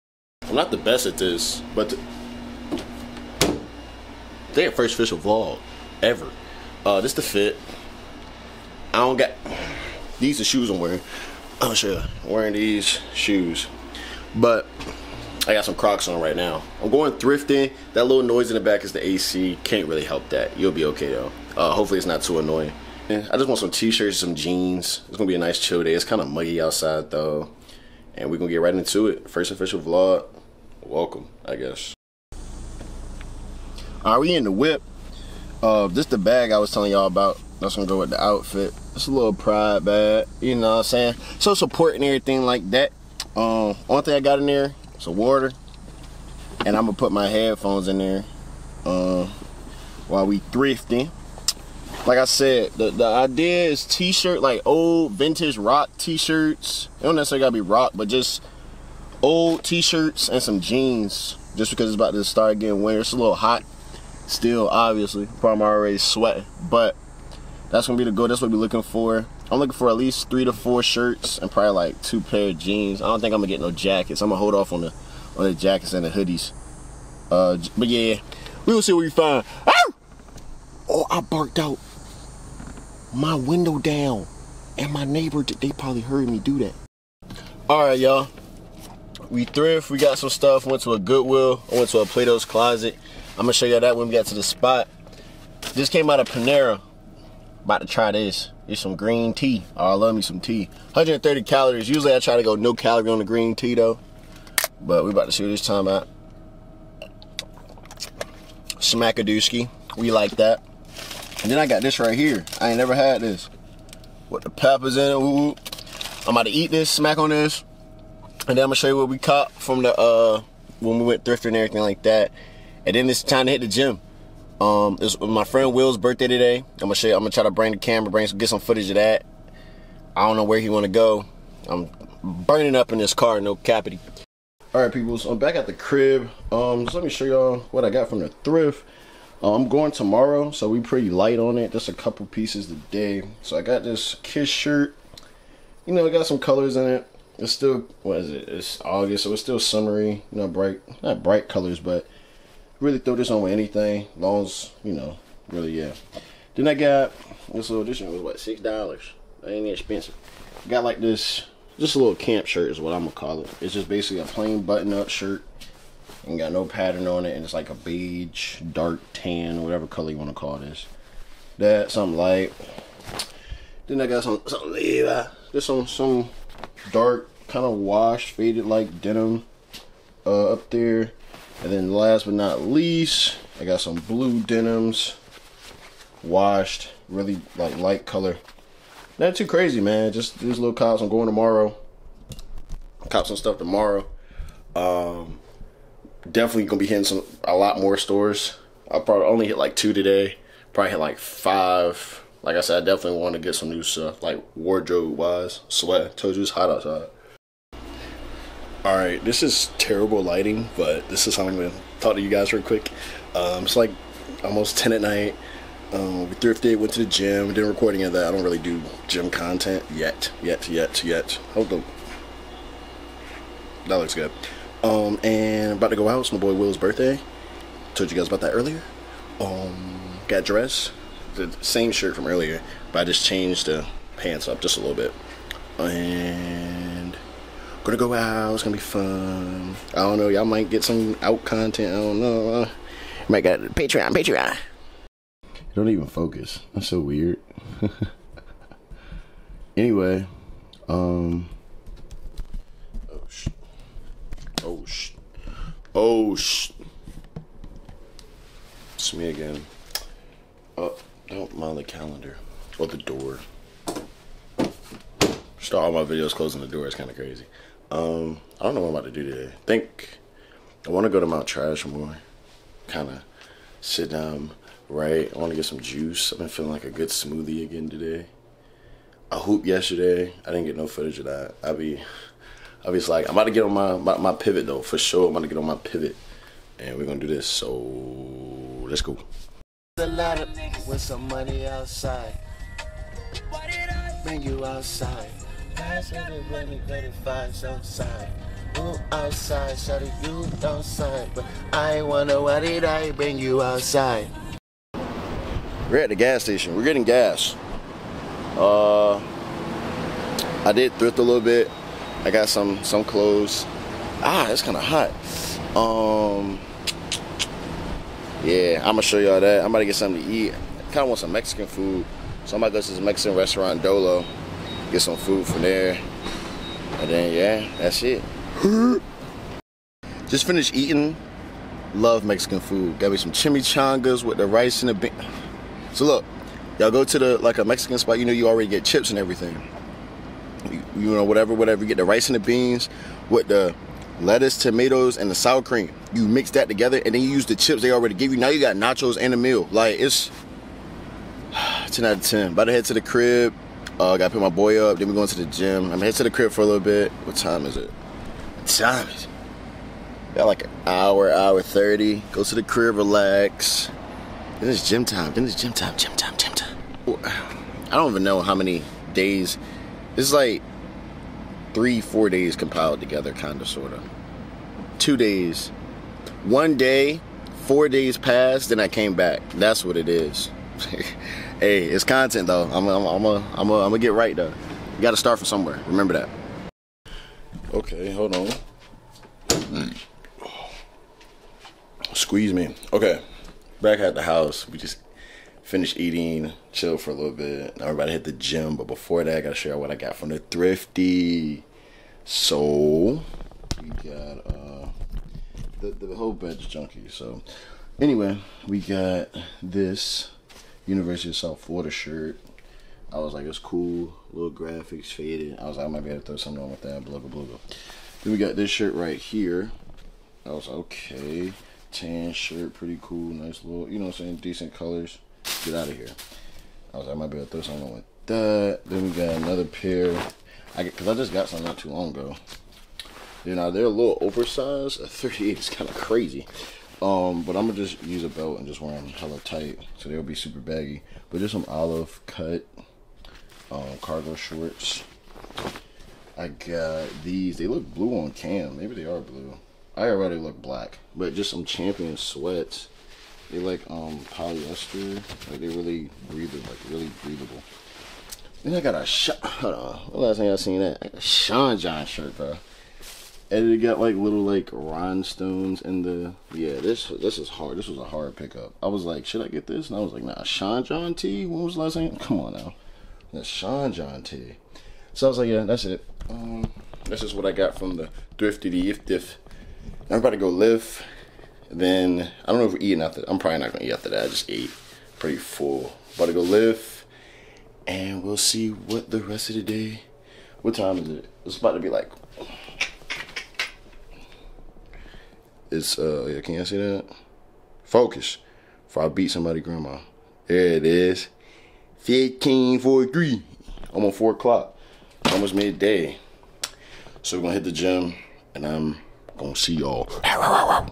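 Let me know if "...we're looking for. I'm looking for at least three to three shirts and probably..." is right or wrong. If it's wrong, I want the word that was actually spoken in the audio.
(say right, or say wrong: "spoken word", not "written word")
wrong: "four", not "three".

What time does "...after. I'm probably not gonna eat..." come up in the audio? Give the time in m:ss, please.
8:03.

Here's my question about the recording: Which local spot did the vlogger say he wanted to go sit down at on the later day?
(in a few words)
Mount Trashmore.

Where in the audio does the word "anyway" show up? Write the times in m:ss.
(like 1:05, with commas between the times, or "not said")
4:09, 6:47.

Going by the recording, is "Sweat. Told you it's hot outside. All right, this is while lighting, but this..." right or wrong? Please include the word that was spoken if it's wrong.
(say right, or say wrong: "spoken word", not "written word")
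wrong: "terrible", not "while".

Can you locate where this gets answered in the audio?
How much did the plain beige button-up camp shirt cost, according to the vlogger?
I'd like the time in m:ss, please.
2:38.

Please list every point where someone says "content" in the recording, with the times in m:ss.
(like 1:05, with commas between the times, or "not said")
3:39, 4:01, 6:22.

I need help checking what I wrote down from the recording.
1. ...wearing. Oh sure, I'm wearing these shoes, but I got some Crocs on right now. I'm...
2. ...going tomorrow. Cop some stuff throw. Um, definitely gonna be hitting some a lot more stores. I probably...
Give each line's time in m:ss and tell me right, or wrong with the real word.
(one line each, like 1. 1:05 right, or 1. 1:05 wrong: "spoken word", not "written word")
1. 0:10 right
2. 3:11 wrong: "tomorrow", not "throw".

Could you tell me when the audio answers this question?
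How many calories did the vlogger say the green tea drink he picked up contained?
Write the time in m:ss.
1:40.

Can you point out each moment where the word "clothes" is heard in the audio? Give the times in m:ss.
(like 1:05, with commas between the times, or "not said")
5:13.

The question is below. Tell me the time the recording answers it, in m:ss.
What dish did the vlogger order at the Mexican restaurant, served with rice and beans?
5:33.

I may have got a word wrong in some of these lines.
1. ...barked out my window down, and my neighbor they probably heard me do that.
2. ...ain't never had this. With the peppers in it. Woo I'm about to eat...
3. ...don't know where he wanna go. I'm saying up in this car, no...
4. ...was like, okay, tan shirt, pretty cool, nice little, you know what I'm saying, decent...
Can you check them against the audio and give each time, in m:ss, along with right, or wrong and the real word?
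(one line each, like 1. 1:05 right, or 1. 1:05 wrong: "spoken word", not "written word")
1. 1:21 right
2. 1:52 right
3. 2:10 wrong: "burning", not "saying"
4. 7:00 right.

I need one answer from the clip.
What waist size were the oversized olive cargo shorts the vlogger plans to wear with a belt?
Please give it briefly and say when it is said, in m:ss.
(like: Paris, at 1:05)
38, at 7:15.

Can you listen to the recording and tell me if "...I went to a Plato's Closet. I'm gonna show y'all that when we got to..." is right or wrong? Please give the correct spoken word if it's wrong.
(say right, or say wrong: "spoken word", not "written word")
right.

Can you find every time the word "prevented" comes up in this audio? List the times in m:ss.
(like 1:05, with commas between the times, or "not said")
not said.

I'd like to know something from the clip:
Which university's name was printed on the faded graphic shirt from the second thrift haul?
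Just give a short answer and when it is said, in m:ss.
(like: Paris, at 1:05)
University of South Florida, at 6:50.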